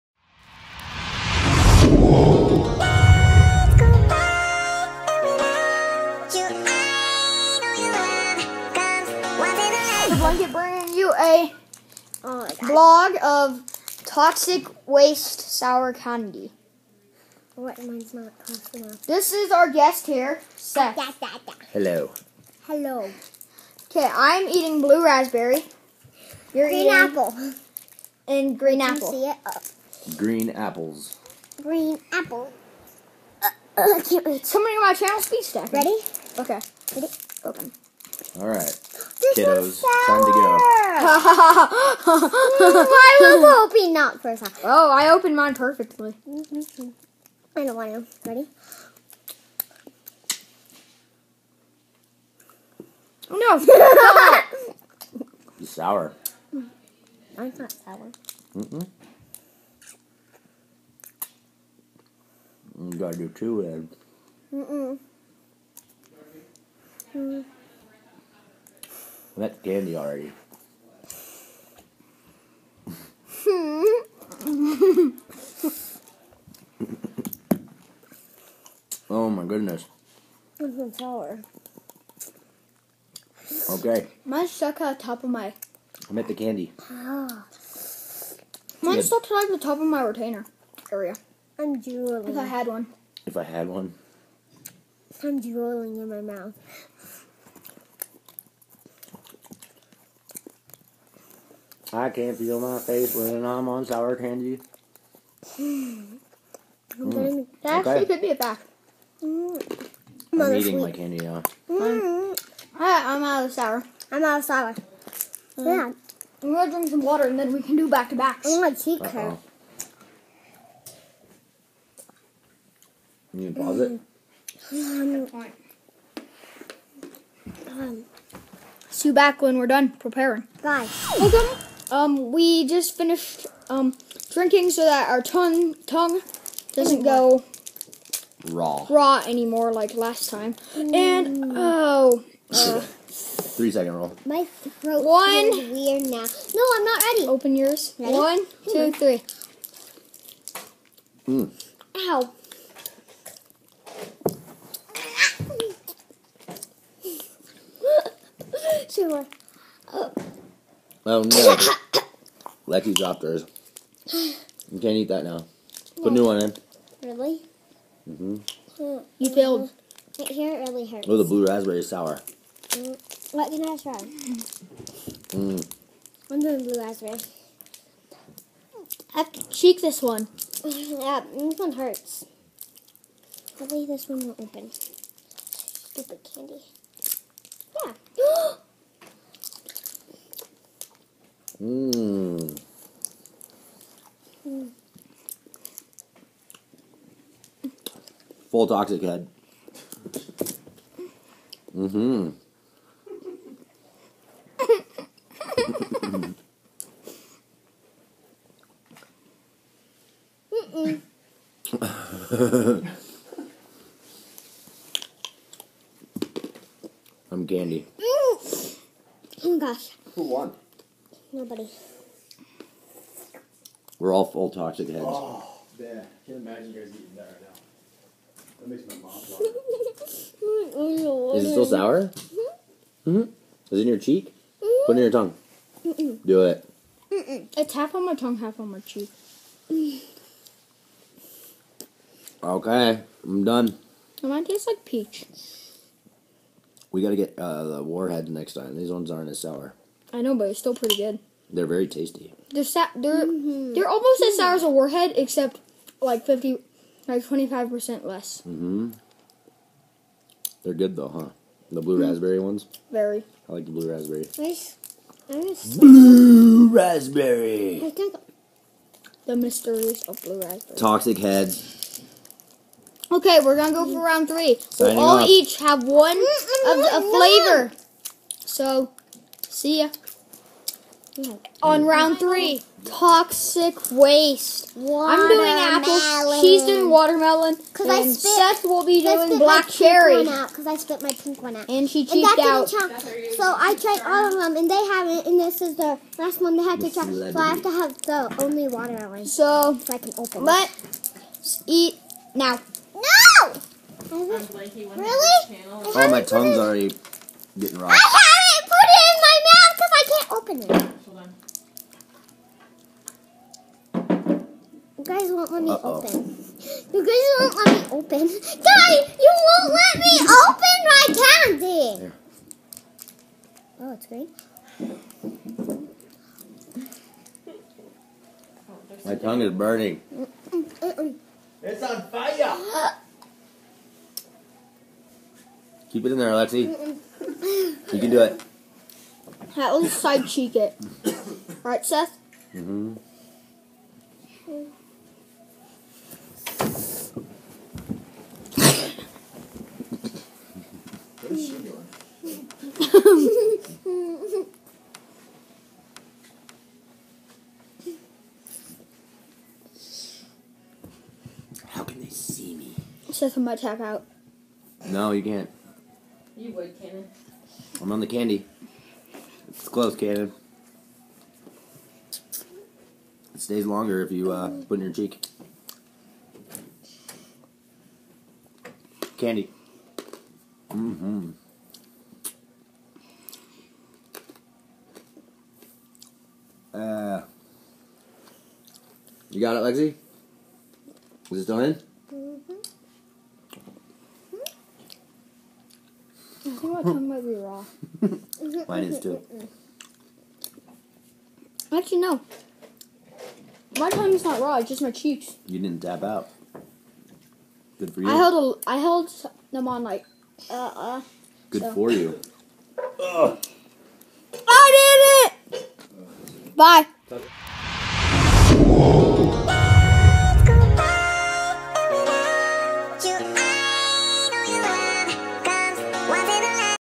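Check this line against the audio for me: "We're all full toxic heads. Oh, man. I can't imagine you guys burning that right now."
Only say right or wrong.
wrong.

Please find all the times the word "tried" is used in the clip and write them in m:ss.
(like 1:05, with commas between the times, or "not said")
4:53.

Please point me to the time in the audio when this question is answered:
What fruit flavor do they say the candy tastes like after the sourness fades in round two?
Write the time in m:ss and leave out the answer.
4:04.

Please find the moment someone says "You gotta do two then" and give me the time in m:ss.
1:02.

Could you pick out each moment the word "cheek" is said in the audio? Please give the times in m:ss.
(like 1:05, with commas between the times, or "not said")
2:59, 3:53, 3:58, 5:40, 6:14, 6:44.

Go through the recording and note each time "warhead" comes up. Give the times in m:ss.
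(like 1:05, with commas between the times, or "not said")
4:07, 4:14.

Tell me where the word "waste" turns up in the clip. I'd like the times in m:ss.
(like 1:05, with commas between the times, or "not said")
0:14, 4:43.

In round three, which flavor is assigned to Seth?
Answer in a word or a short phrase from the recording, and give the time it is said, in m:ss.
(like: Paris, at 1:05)
Black cherry, at 4:49.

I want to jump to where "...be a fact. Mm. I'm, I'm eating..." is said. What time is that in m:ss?
1:48.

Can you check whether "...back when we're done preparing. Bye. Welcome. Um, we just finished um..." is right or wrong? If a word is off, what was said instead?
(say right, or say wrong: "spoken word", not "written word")
right.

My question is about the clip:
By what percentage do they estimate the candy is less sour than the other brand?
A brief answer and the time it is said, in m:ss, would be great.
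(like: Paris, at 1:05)
25%, at 4:17.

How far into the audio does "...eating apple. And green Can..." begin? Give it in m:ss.
0:26.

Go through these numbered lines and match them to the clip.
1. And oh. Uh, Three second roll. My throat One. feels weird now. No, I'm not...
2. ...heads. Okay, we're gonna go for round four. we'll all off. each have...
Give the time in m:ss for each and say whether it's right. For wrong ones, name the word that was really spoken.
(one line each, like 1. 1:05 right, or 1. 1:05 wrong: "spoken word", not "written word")
1. 2:20 right
2. 4:31 wrong: "three", not "four".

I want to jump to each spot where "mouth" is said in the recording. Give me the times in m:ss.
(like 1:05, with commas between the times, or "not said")
1:36, 5:09.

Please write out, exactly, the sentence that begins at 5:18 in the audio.
Guys, you won't let me open my candy.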